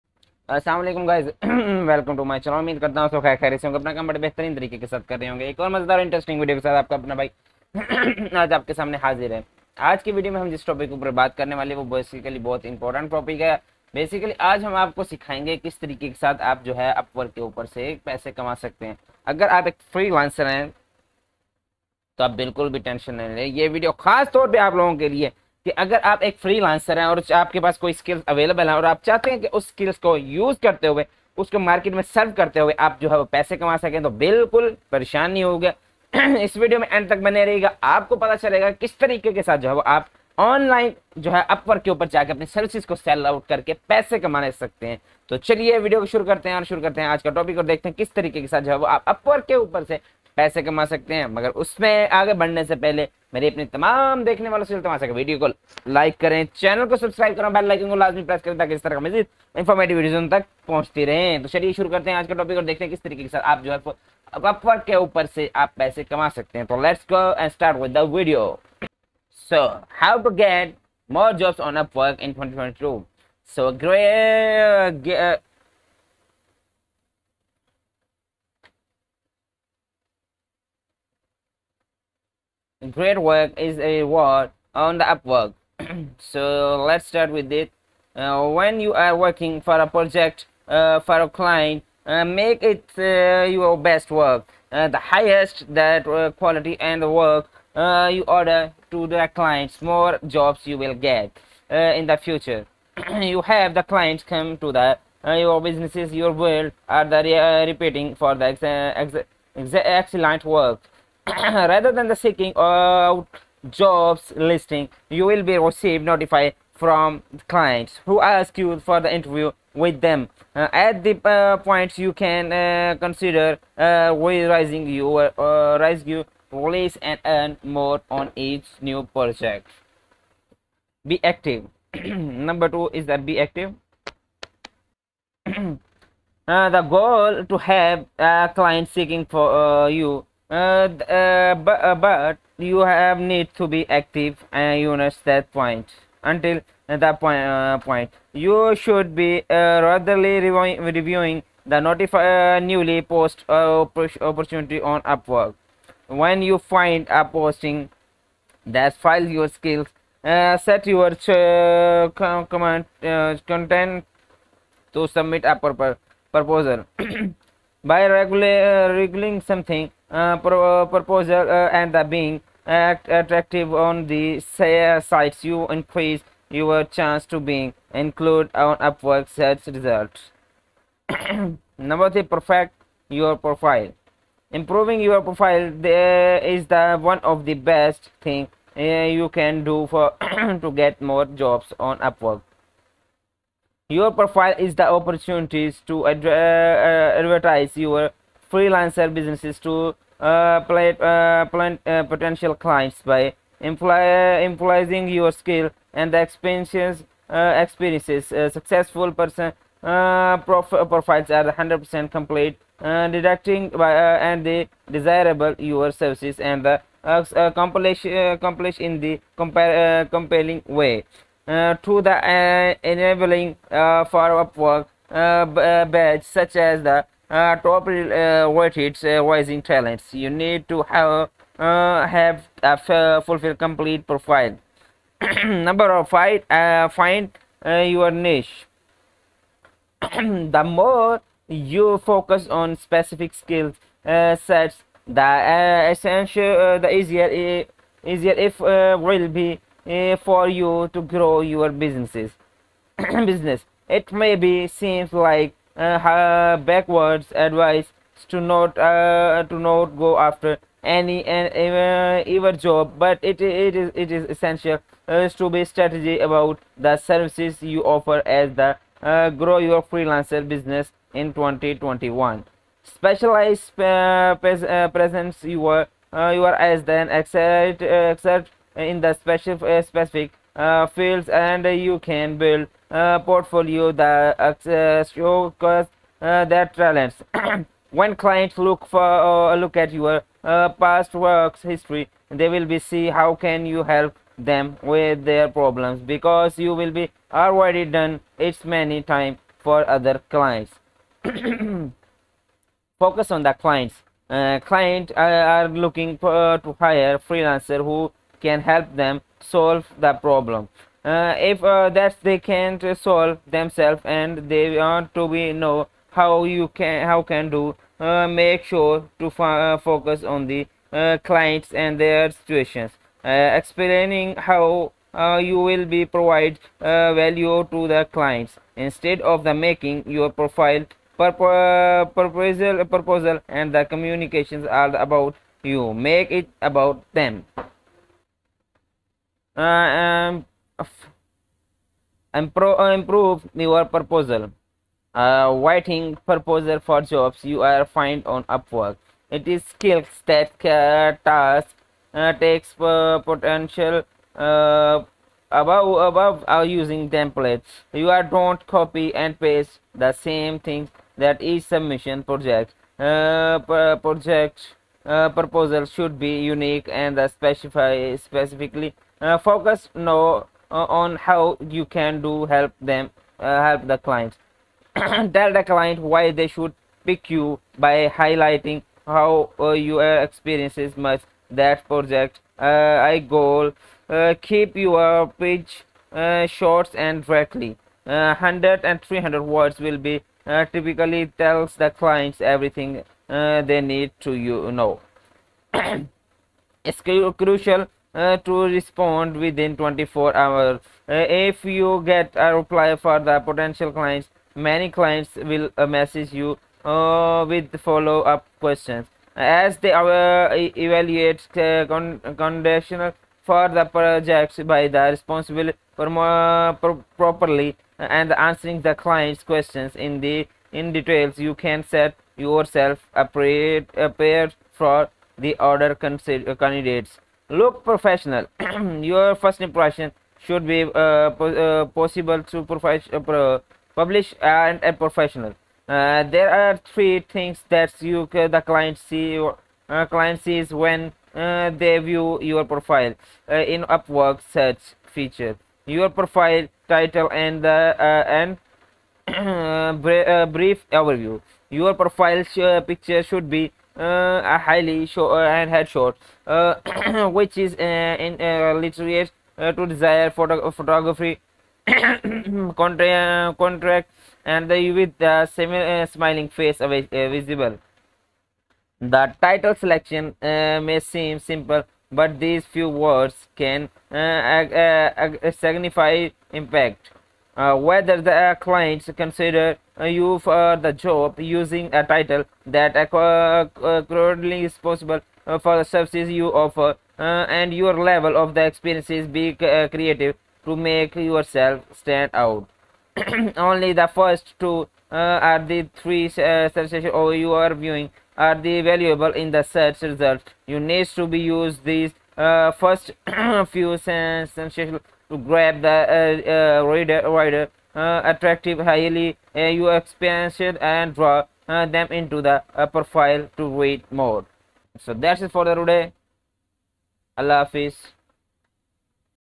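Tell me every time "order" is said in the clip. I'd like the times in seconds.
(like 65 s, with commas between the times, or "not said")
98 s, 425 s.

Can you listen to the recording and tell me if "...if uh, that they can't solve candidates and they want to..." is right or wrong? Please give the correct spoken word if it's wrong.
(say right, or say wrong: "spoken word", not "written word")
wrong: "themselves", not "candidates".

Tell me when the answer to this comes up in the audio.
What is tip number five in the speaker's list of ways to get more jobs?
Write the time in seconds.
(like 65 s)
236 s.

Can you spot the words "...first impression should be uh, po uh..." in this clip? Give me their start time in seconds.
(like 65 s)
429 s.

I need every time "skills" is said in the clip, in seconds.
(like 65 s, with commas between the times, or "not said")
159 s, 205 s, 243 s, 349 s.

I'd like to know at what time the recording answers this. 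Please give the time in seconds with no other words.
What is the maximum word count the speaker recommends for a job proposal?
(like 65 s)
389 s.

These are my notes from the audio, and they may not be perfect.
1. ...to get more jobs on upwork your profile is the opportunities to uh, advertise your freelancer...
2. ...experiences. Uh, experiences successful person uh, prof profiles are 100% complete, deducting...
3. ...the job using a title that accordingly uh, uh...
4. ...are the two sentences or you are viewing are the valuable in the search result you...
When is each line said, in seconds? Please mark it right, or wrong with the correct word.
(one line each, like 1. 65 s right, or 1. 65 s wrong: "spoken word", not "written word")
1. 190 s right
2. 206 s right
3. 480 s right
4. 495 s wrong: "three", not "two".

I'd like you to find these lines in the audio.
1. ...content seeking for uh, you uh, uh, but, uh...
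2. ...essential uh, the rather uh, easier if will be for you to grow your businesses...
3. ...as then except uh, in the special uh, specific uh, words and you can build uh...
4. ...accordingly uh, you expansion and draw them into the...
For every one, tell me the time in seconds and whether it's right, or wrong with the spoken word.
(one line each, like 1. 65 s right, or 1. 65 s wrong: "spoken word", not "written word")
1. 138 s wrong: "client", not "content"
2. 245 s wrong: "easier", not "rather"
3. 276 s wrong: "fields", not "words"
4. 508 s wrong: "highly", not "accordingly".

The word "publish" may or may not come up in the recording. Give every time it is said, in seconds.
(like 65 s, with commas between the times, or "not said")
433 s.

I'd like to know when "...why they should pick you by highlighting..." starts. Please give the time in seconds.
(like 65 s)
376 s.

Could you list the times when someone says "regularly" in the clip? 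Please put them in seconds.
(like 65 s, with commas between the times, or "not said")
149 s, 168 s.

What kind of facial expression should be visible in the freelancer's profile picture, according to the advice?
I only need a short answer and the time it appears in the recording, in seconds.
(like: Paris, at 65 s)
Semi smiling, at 465 s.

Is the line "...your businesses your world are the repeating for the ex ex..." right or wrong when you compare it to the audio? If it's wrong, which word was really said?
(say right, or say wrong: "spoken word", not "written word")
right.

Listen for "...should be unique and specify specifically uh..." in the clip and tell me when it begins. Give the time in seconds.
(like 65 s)
365 s.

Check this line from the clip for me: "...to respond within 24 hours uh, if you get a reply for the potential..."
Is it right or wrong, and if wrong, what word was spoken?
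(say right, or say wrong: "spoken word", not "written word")
right.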